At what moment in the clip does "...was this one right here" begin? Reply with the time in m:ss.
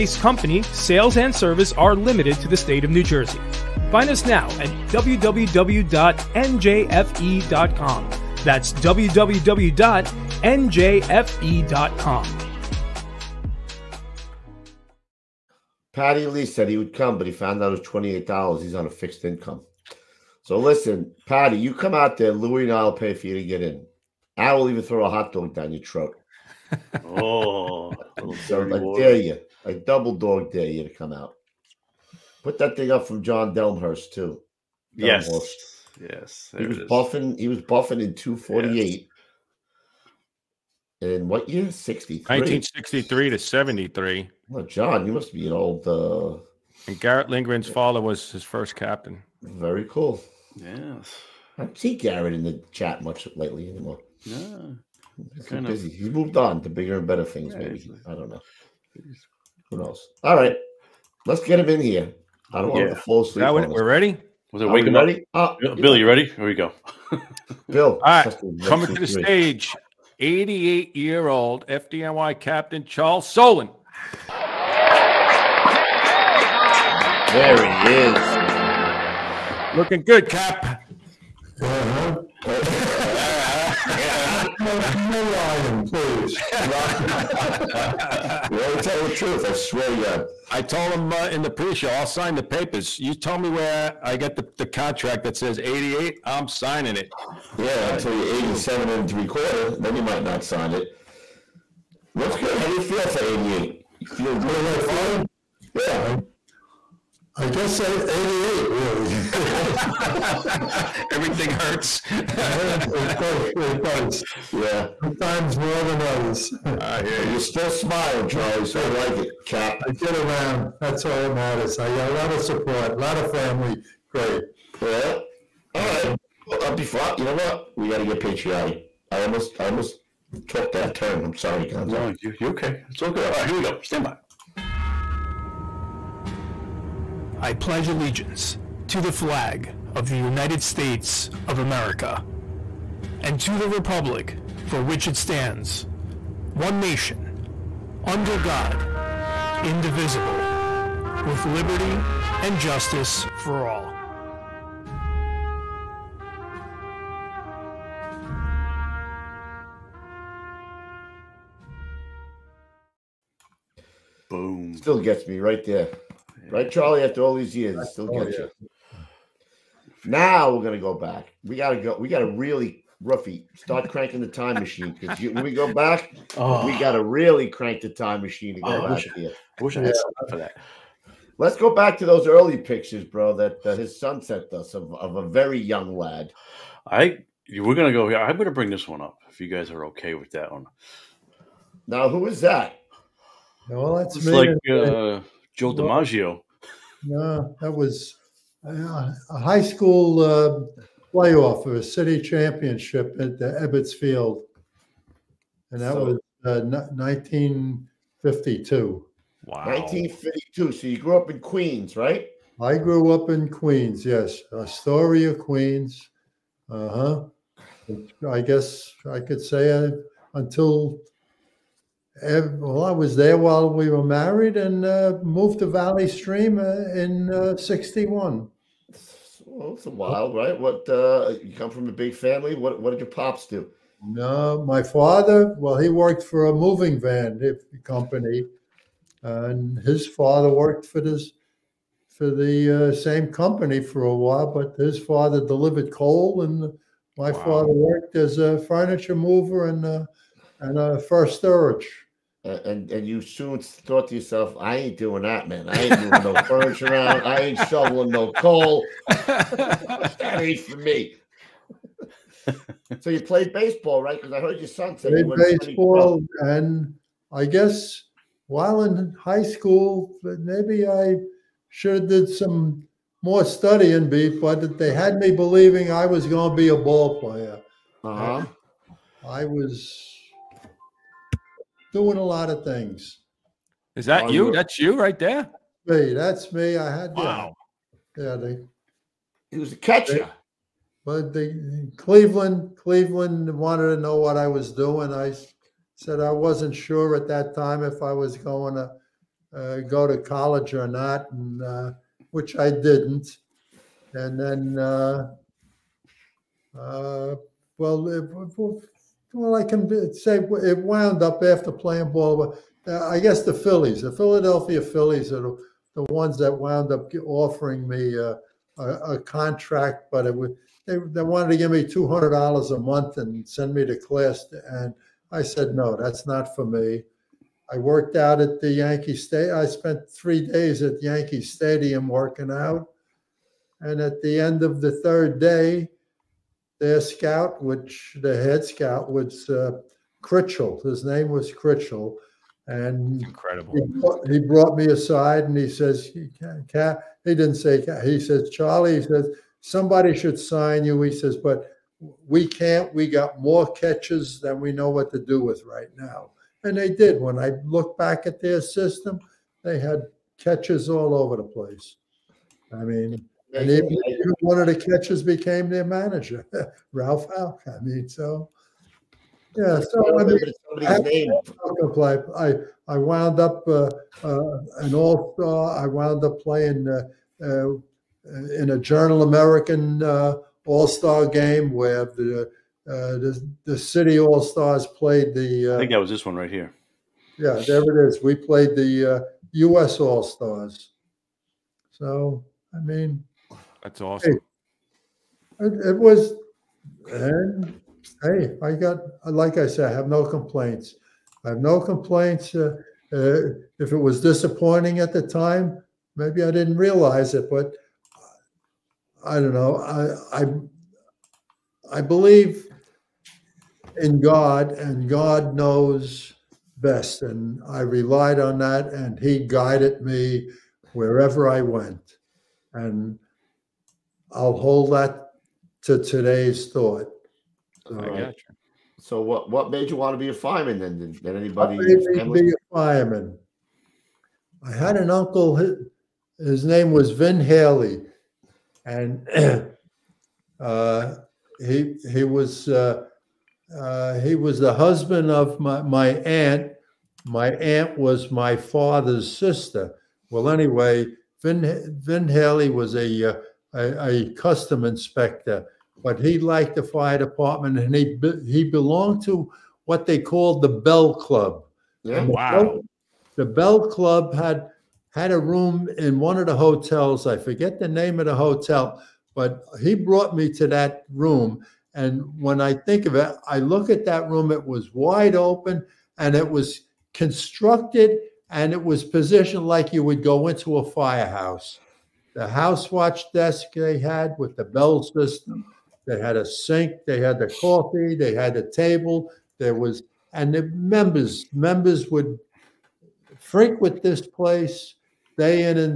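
6:25.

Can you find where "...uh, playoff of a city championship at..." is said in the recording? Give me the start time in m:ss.
3:20.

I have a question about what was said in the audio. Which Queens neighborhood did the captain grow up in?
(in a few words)
Astoria.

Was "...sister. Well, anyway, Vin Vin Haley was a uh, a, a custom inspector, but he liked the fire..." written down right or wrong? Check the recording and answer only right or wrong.
right.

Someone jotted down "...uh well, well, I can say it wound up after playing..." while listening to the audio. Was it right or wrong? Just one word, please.
right.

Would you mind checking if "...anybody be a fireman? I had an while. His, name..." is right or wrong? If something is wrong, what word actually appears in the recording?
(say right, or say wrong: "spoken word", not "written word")
wrong: "uncle", not "while".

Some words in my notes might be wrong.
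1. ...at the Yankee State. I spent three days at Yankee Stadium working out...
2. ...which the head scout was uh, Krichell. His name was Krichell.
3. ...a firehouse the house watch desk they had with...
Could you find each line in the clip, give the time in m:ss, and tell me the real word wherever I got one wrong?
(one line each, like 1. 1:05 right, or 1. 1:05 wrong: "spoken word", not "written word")
1. 5:28 right
2. 5:37 right
3. 8:00 right.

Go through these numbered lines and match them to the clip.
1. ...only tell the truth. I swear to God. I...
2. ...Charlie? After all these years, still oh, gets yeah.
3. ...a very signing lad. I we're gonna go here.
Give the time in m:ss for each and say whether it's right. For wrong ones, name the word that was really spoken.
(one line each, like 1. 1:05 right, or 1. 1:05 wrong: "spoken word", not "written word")
1. 1:28 right
2. 2:46 right
3. 3:05 wrong: "young", not "signing".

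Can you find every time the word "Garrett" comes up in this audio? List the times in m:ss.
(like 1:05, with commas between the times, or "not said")
0:46, 0:51.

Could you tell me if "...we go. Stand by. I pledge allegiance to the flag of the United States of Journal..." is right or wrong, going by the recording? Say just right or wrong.
wrong.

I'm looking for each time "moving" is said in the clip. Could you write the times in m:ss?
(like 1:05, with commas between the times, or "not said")
3:56, 4:15.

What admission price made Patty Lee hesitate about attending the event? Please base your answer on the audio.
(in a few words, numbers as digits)
$28.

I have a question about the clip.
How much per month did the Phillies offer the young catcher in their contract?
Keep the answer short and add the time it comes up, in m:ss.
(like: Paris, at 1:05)
$200, at 5:21.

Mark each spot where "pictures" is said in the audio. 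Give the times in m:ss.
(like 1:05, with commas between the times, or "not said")
3:02.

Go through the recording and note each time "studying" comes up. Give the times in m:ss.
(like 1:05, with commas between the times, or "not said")
4:33.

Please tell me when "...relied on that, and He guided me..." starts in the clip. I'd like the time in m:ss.
6:57.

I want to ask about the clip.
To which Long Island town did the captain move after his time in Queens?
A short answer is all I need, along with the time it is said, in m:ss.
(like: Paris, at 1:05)
Valley Stream, at 3:45.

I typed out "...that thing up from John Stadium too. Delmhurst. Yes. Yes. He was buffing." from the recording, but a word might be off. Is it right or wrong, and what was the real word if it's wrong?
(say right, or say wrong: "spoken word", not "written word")
wrong: "Delmhurst", not "Stadium".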